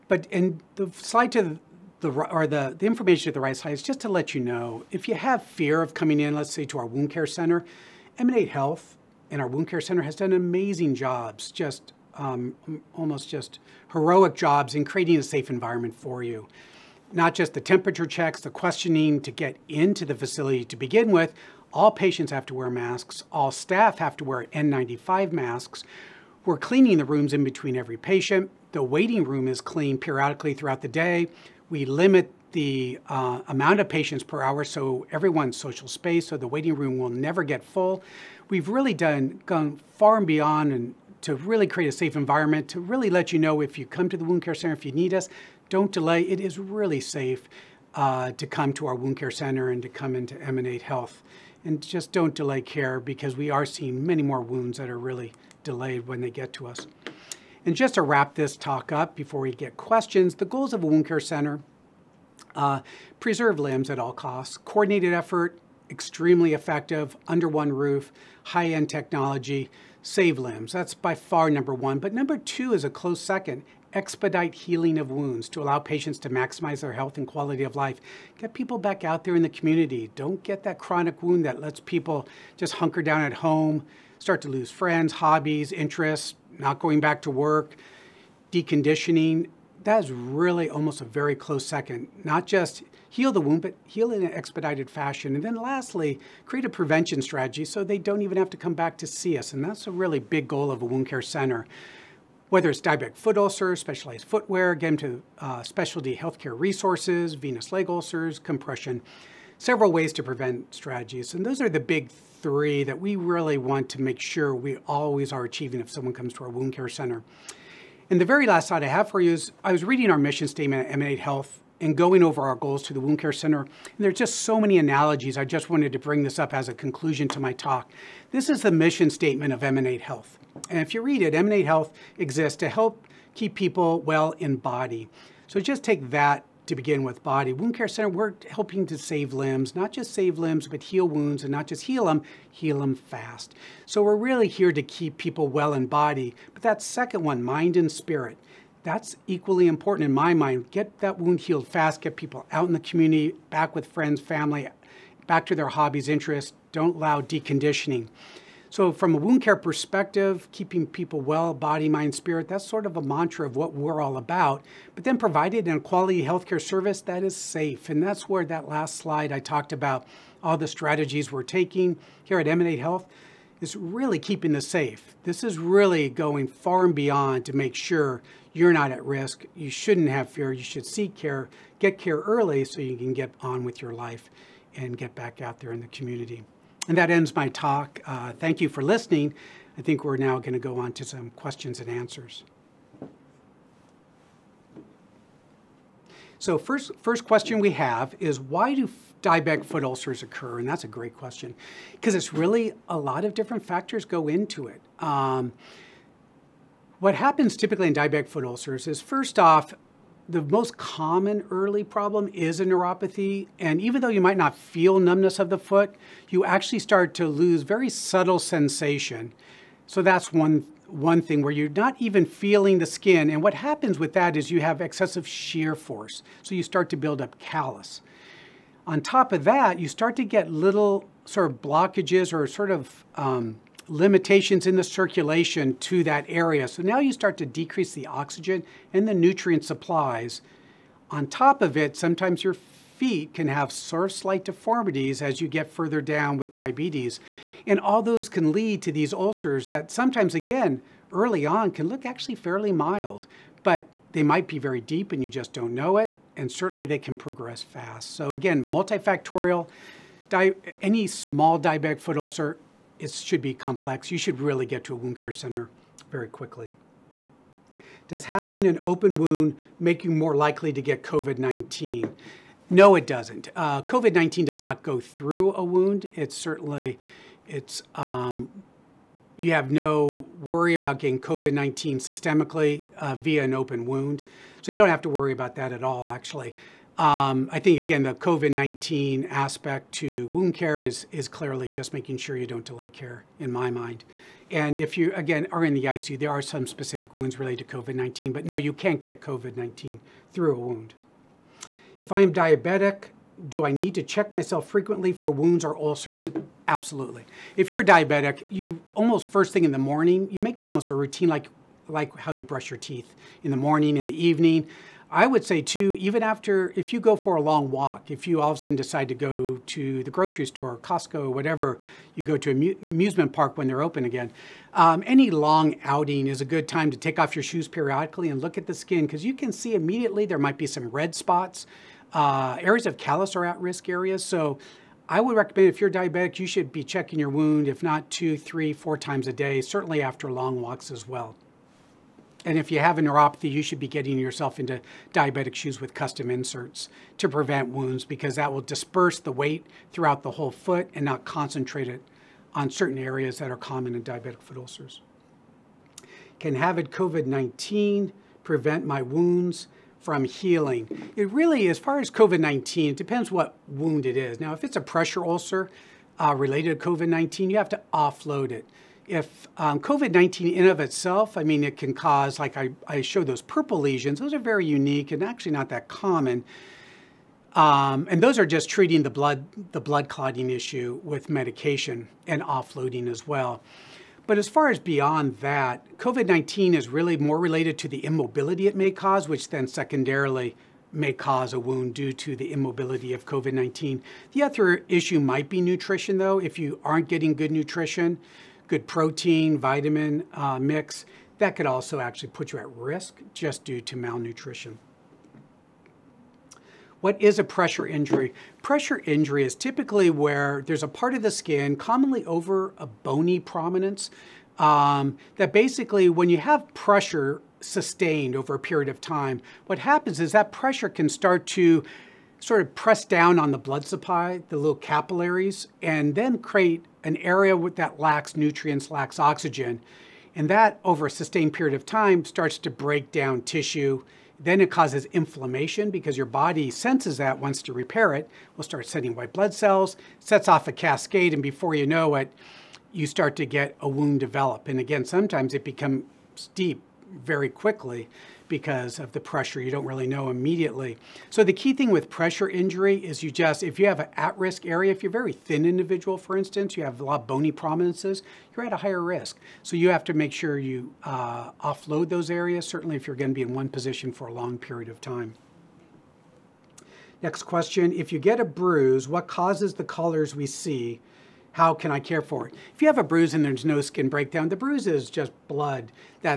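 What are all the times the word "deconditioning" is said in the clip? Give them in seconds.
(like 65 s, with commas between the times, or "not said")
88 s, 157 s.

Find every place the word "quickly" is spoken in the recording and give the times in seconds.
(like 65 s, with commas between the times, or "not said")
266 s, 447 s.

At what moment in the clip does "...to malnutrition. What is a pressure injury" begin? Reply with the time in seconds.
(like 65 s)
403 s.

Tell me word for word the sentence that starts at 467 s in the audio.
Next question, if you get a bruise, what causes the colors we see?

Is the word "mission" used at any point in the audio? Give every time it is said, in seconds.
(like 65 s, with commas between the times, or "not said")
120 s, 128 s.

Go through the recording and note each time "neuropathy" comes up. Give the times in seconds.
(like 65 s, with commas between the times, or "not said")
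212 s, 343 s.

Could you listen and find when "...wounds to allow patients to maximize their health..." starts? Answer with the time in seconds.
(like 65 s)
75 s.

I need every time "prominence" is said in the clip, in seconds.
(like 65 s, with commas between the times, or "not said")
413 s, 457 s.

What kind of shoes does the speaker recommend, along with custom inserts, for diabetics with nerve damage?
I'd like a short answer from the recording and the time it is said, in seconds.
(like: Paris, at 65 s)
Diabetic shoes, at 345 s.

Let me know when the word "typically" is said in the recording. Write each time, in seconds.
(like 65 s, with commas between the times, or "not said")
207 s, 409 s.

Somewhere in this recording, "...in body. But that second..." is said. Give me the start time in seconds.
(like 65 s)
145 s.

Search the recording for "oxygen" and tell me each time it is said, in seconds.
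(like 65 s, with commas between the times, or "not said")
238 s, 429 s.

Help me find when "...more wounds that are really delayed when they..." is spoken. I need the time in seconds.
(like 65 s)
54 s.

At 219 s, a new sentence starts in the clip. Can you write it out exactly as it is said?
So that's one, one thing where you're not even feeling the skin.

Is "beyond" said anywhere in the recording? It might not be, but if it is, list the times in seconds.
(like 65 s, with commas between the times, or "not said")
40 s, 176 s, 384 s.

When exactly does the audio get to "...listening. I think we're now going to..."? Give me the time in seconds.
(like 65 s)
188 s.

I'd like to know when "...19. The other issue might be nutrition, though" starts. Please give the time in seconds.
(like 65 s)
393 s.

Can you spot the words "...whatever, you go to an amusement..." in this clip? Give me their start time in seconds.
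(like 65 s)
321 s.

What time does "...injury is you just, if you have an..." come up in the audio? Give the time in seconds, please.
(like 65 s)
452 s.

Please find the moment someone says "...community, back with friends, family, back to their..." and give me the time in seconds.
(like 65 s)
152 s.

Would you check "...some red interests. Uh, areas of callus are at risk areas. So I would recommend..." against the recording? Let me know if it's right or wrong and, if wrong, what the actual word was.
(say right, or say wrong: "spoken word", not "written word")
wrong: "spots", not "interests".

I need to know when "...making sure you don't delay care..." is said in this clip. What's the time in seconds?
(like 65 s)
291 s.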